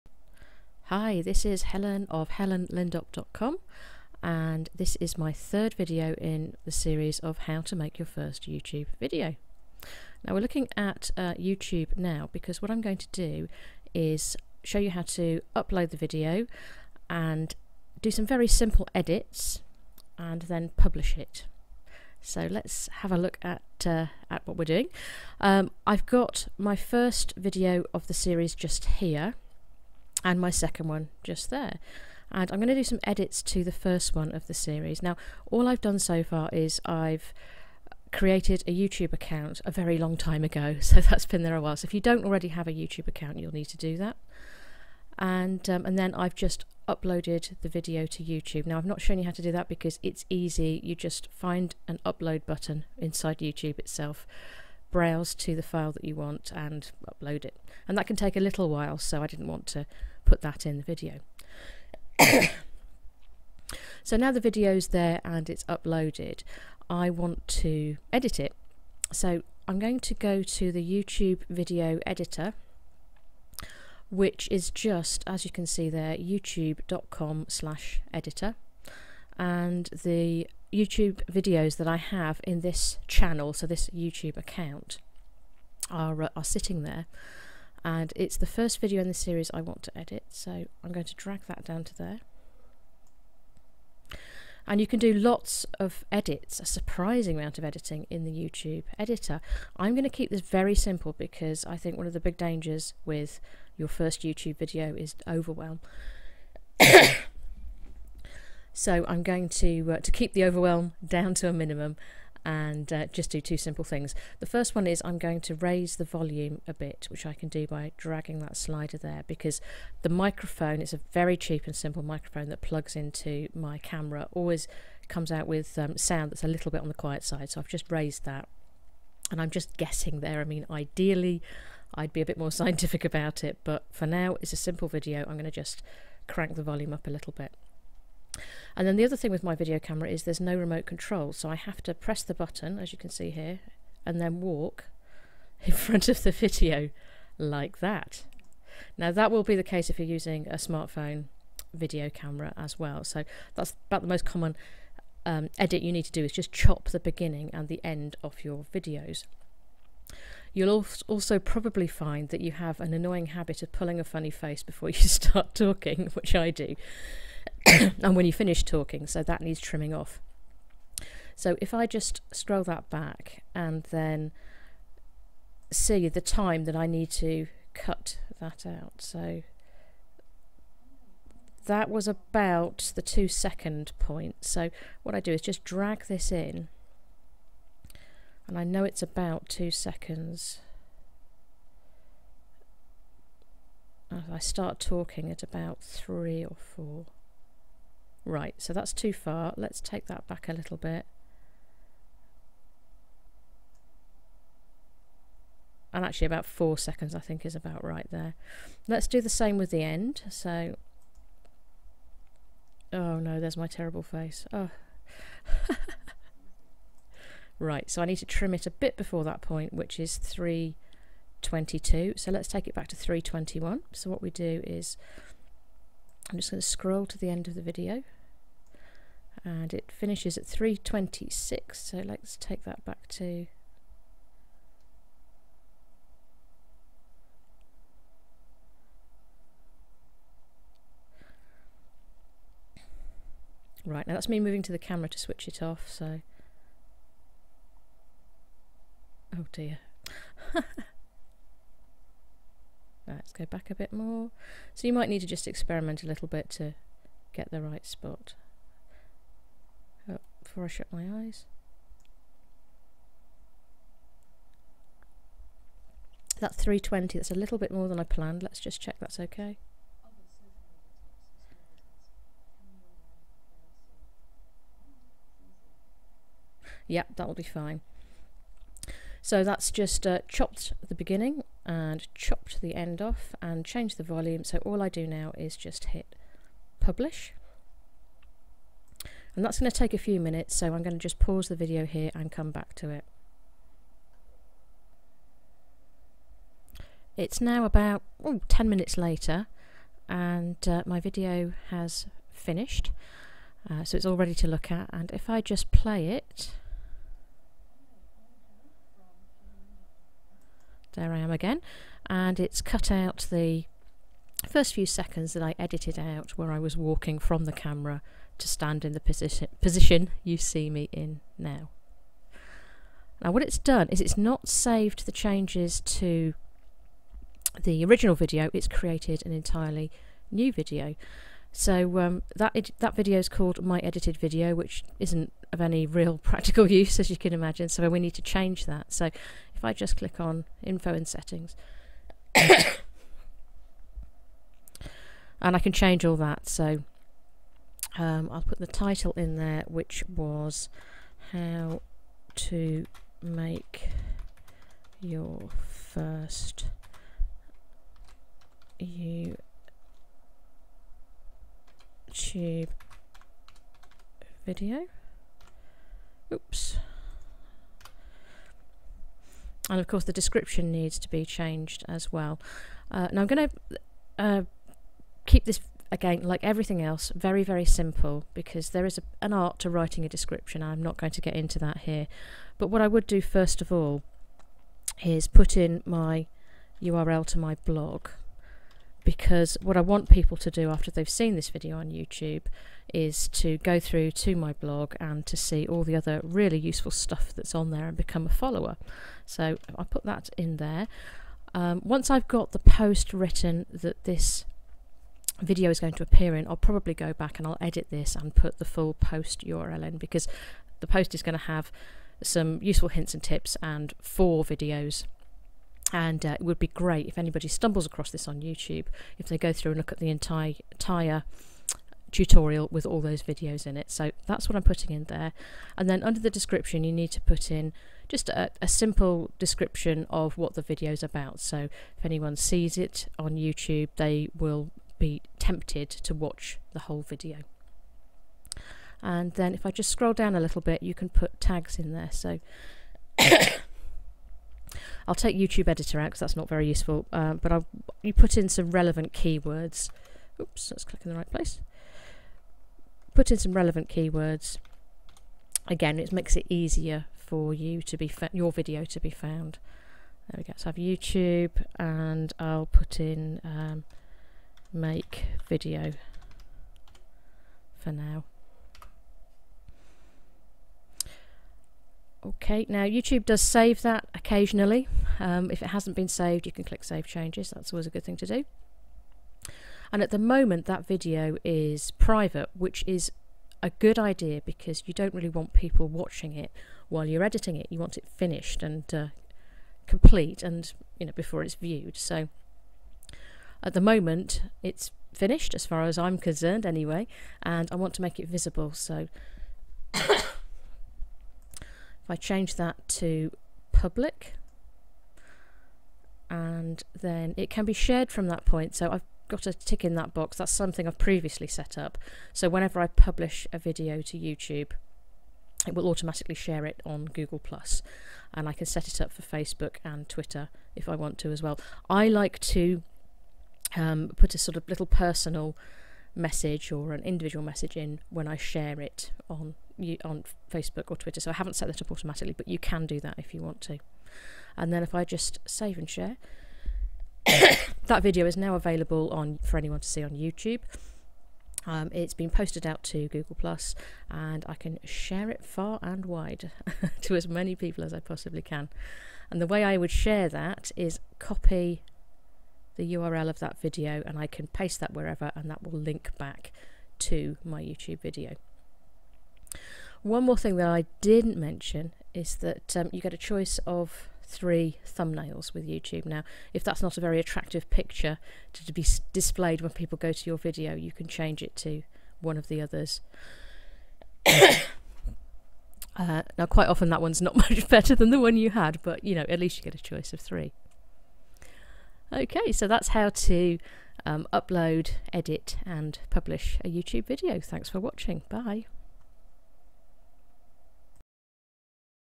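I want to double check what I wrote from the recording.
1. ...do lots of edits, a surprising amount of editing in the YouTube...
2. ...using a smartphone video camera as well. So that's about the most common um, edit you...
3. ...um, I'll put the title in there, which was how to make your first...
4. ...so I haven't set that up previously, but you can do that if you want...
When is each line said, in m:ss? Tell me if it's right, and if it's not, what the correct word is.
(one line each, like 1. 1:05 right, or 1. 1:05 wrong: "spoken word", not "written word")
1. 1:34 right
2. 2:30 right
3. 5:47 right
4. 8:51 wrong: "automatically", not "previously".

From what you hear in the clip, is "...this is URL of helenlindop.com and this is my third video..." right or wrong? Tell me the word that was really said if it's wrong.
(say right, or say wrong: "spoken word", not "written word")
wrong: "Helen", not "URL".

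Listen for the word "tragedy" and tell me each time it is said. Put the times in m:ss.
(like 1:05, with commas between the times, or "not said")
not said.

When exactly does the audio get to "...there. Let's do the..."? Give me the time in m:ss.
3:28.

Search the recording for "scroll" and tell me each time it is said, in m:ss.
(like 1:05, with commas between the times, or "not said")
2:52, 3:46, 7:19.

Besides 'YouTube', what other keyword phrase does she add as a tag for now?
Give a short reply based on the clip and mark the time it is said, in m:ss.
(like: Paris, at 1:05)
make video, at 7:44.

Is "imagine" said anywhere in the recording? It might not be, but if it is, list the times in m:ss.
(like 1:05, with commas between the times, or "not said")
5:37.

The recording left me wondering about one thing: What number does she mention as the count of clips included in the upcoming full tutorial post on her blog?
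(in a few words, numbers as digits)
4.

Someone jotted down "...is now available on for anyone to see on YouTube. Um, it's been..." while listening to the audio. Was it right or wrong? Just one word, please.
right.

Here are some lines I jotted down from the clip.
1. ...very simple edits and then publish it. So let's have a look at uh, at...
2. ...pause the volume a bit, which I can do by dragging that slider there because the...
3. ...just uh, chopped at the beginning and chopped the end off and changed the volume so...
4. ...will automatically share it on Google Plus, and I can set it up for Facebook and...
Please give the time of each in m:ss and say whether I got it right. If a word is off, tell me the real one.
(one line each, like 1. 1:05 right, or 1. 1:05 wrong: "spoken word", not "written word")
1. 0:18 right
2. 1:55 wrong: "raise", not "pause"
3. 4:39 right
4. 8:35 right.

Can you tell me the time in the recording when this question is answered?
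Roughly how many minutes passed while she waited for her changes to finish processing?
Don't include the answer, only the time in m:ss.
4:58.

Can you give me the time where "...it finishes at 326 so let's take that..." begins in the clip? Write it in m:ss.
3:49.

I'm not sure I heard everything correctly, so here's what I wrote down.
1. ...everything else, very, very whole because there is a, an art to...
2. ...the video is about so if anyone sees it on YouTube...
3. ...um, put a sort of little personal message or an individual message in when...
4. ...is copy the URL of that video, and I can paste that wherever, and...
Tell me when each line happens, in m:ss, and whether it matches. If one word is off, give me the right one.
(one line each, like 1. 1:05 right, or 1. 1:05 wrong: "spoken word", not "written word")
1. 6:16 wrong: "simple", not "whole"
2. 7:10 right
3. 8:43 right
4. 9:10 right.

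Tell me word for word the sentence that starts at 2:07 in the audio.
So I've just raised that and I'm just guessing there.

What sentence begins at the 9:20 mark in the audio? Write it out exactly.
One more thing that I didn't mention is that um, you get a choice of three thumbnails with YouTube.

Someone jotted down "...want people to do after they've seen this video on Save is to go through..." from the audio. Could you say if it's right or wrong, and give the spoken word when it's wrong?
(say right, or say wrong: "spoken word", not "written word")
wrong: "YouTube", not "Save".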